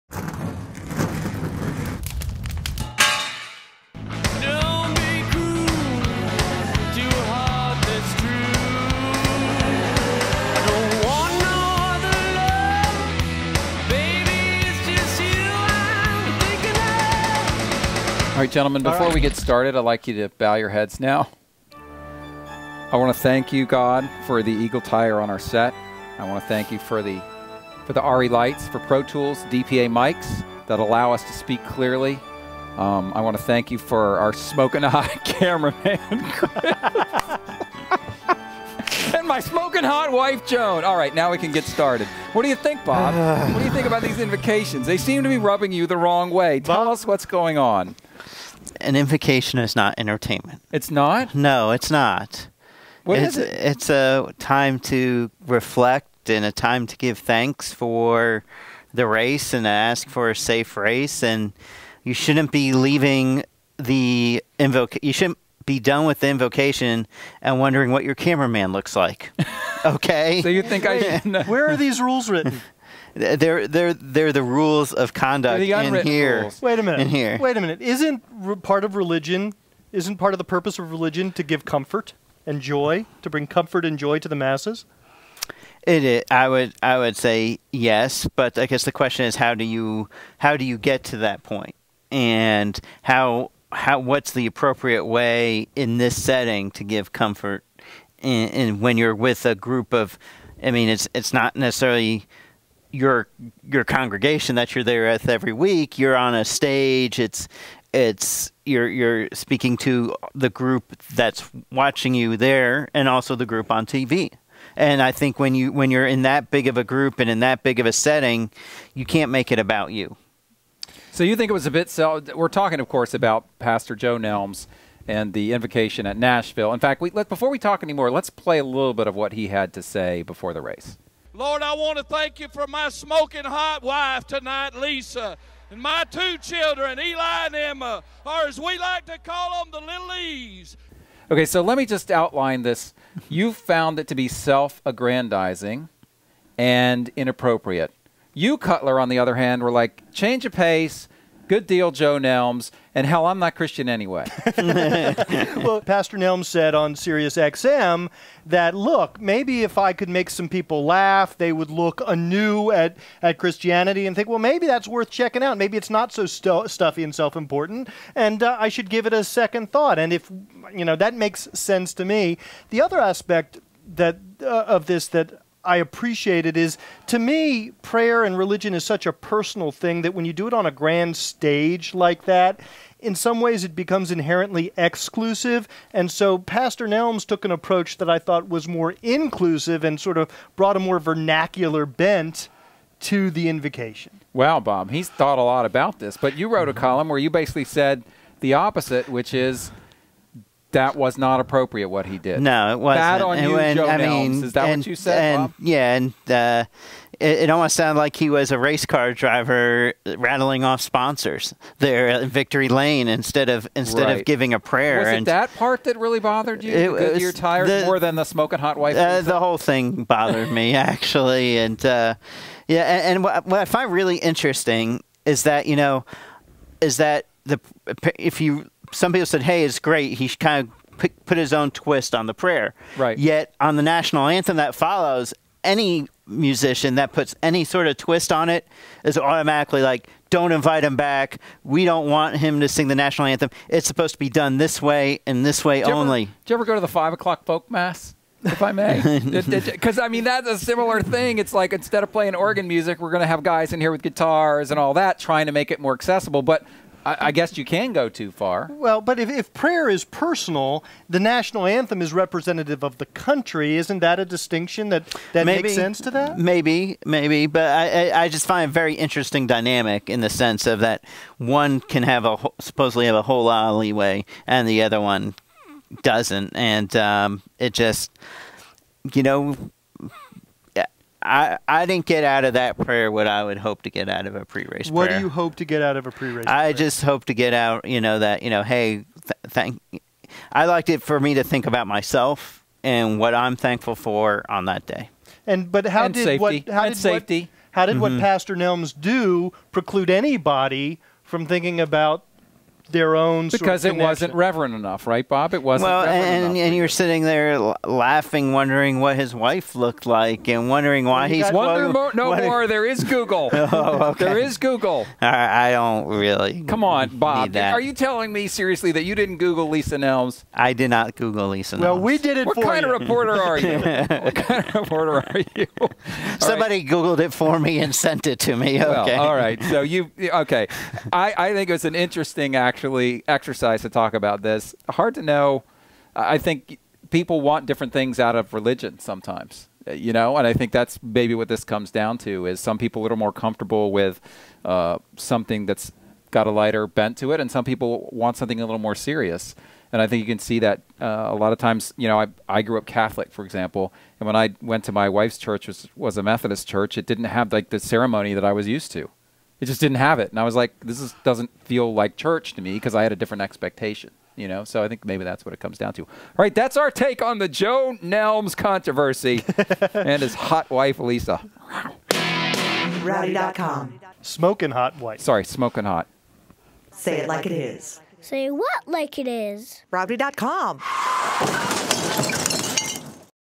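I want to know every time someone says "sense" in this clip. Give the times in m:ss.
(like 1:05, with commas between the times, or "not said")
2:51, 4:25, 4:30.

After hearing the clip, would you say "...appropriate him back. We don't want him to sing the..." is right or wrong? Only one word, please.
wrong.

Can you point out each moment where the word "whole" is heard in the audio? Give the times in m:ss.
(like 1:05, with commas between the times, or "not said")
3:39, 4:33.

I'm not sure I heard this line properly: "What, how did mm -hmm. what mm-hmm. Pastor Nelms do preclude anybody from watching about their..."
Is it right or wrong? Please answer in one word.
wrong.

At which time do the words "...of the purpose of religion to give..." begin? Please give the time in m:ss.
1:20.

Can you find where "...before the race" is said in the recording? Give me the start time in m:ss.
2:10.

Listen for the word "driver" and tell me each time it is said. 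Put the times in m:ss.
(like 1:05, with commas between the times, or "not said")
3:29.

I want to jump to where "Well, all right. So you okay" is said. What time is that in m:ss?
5:29.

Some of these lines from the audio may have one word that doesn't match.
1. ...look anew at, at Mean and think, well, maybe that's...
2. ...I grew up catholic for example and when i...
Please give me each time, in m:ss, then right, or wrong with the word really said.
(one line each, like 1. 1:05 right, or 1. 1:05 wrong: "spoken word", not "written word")
1. 2:41 wrong: "Christianity", not "Mean"
2. 5:52 right.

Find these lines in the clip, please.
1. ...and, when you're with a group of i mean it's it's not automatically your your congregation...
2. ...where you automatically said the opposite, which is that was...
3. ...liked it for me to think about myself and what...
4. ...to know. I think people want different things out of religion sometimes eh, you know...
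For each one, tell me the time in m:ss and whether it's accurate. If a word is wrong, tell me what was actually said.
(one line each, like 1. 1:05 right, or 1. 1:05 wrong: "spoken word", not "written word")
1. 1:38 wrong: "necessarily", not "automatically"
2. 3:17 wrong: "basically", not "automatically"
3. 4:50 right
4. 5:35 right.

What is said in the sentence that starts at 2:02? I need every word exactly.
We're talking, of course, about Pastor Joe Nelms and the invocation at Nashville.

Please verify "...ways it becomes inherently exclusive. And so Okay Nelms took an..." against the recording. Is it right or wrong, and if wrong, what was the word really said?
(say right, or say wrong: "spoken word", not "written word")
wrong: "Pastor", not "Okay".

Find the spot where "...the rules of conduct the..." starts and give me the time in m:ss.
1:14.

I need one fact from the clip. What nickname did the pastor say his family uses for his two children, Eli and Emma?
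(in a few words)
the little E's.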